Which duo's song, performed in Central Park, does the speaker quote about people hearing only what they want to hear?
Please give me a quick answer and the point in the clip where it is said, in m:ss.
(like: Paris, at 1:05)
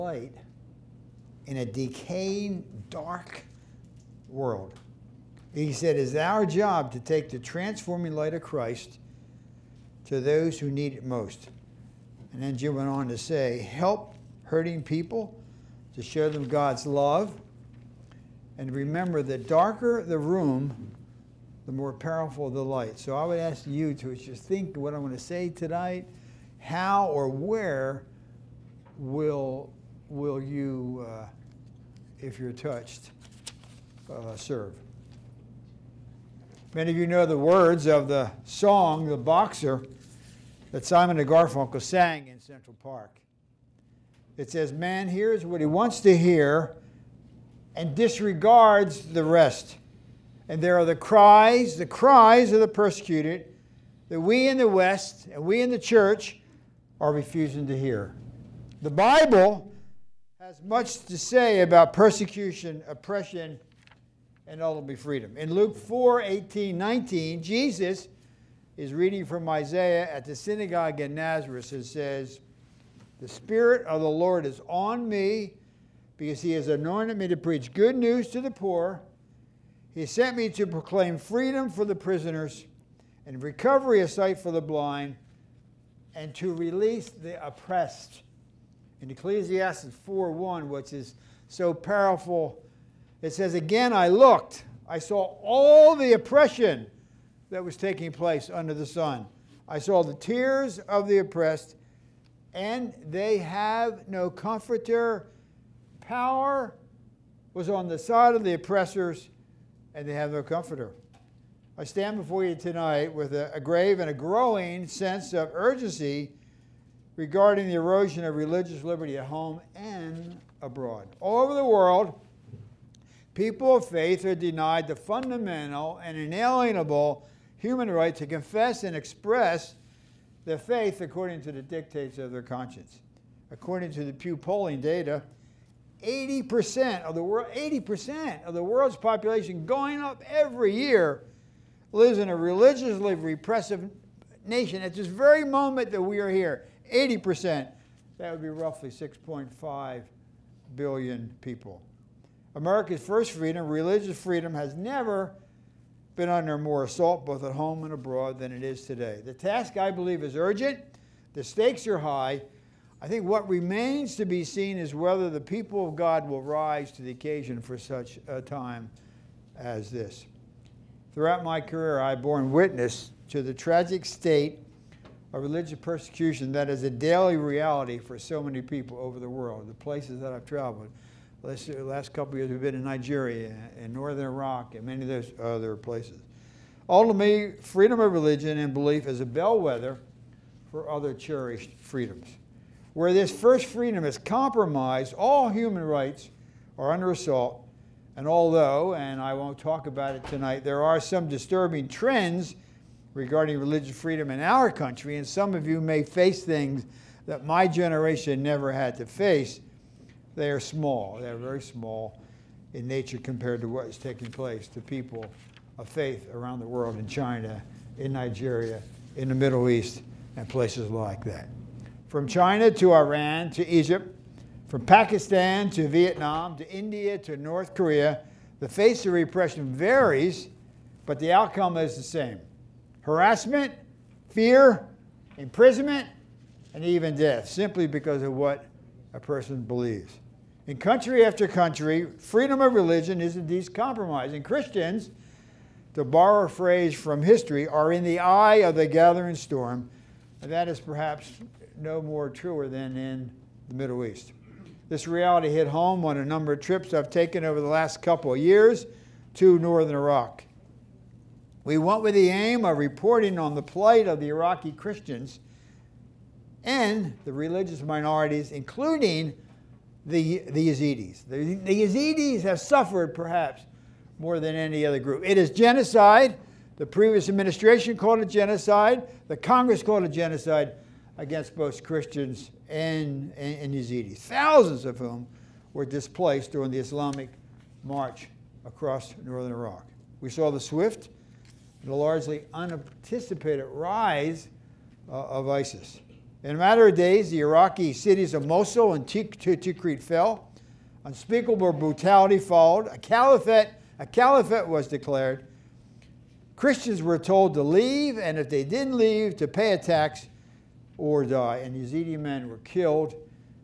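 Simon and Garfunkel, at 0:40.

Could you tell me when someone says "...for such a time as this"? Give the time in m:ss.
2:47.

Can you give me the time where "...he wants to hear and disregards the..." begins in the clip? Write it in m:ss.
0:45.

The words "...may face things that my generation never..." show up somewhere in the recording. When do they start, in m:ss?
3:25.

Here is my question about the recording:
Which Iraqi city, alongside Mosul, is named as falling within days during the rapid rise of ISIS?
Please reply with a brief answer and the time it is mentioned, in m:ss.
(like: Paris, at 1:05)
Tikrit, at 4:59.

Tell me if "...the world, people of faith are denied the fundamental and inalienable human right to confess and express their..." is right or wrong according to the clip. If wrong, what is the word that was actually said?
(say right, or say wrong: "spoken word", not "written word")
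right.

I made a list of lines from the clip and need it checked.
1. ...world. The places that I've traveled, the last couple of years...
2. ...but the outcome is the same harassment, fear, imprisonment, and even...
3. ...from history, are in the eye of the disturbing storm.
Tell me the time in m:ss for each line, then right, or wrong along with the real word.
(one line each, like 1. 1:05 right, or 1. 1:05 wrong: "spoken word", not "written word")
1. 2:59 right
2. 3:51 right
3. 4:06 wrong: "gathering", not "disturbing".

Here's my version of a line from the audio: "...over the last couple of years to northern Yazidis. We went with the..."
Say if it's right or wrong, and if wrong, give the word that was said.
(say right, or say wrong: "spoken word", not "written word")
wrong: "Iraq", not "Yazidis".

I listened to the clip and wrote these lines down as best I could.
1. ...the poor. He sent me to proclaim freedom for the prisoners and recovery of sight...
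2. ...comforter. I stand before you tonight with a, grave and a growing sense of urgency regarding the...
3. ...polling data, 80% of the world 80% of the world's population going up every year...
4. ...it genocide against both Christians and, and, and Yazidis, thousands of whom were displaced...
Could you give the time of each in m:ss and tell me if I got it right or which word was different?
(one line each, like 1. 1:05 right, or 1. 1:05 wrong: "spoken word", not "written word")
1. 1:18 right
2. 1:50 right
3. 2:14 right
4. 4:40 right.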